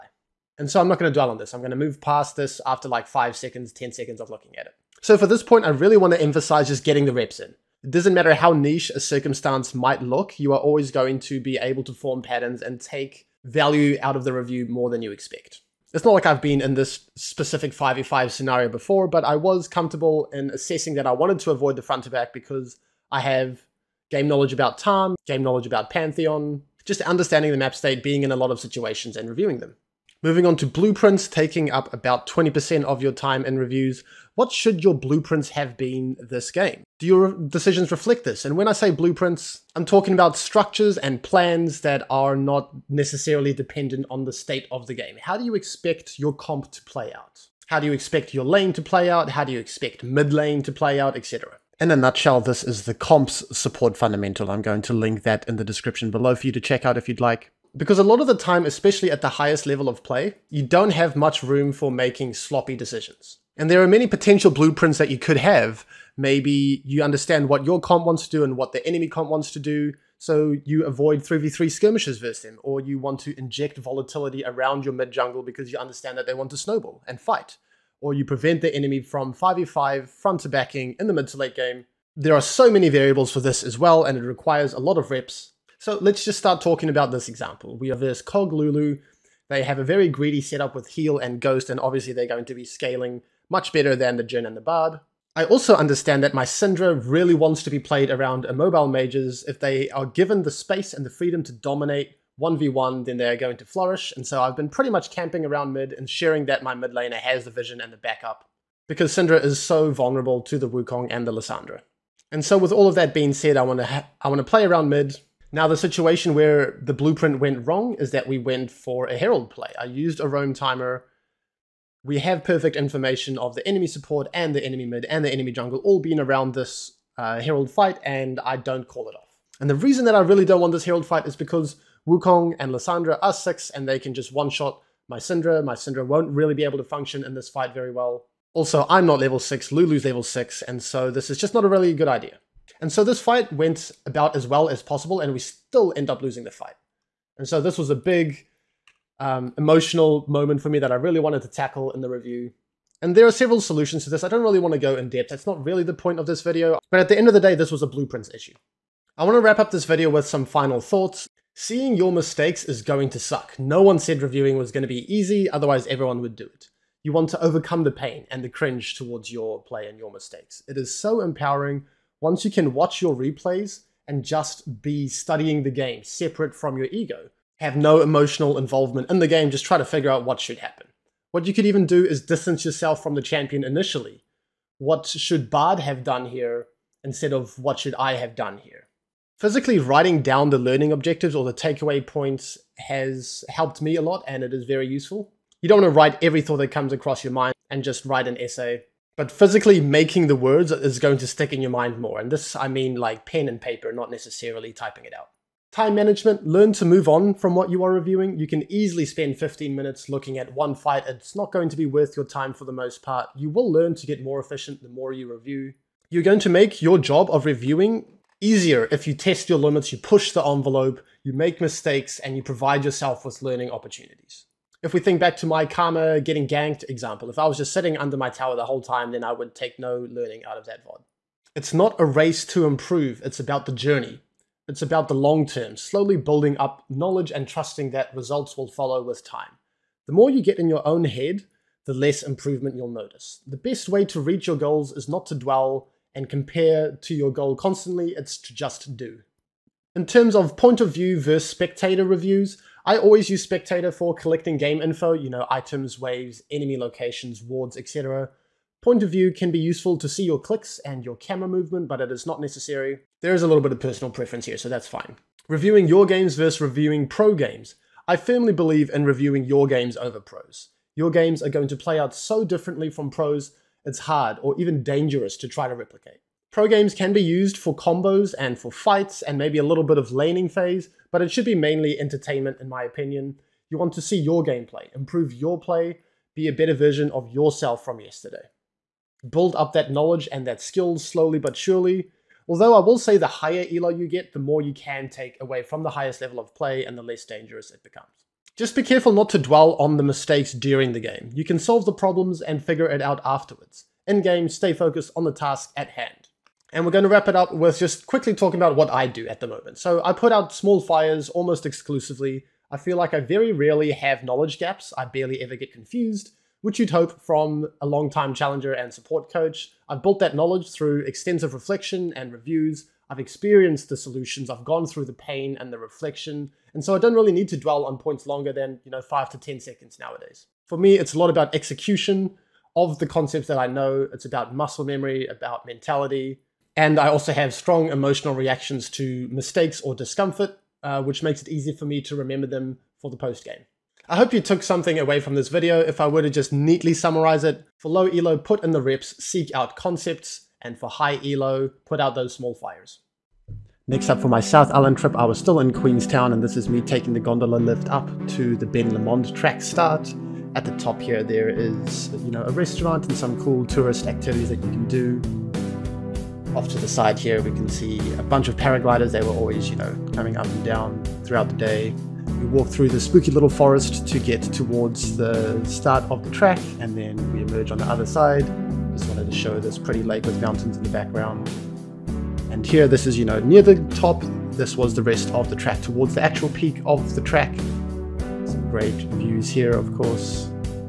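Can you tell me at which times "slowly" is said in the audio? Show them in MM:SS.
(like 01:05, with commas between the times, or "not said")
03:55, 04:51.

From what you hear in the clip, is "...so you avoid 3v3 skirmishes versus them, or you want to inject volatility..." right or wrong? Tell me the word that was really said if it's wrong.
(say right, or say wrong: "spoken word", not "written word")
right.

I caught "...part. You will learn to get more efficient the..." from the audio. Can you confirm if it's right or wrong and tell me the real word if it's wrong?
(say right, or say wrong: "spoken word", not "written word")
right.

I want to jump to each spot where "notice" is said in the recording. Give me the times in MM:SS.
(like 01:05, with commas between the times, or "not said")
04:02.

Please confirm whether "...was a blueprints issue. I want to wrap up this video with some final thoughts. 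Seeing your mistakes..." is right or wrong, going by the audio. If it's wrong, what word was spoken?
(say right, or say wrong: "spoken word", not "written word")
right.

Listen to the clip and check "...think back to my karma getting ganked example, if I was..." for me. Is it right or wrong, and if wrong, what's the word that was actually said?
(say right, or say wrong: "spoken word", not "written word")
right.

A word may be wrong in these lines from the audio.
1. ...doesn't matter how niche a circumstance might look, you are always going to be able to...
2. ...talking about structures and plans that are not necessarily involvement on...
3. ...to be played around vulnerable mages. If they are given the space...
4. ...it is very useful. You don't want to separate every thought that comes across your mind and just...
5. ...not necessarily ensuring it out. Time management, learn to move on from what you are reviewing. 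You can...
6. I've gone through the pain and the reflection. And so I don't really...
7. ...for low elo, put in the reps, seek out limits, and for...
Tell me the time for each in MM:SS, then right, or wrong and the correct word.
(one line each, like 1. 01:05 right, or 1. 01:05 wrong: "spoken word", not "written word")
1. 00:07 right
2. 00:39 wrong: "dependent", not "involvement"
3. 01:37 wrong: "mobile", not "vulnerable"
4. 03:14 wrong: "write", not "separate"
5. 03:23 wrong: "typing", not "ensuring"
6. 05:24 right
7. 05:47 wrong: "concepts", not "limits".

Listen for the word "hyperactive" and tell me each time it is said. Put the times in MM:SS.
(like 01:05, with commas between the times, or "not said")
not said.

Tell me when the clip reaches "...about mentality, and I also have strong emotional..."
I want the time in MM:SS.
05:35.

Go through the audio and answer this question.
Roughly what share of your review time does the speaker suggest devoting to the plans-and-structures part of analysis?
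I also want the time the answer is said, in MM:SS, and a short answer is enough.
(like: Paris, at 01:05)
20%, at 00:32.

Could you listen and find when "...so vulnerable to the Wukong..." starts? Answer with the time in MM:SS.
01:49.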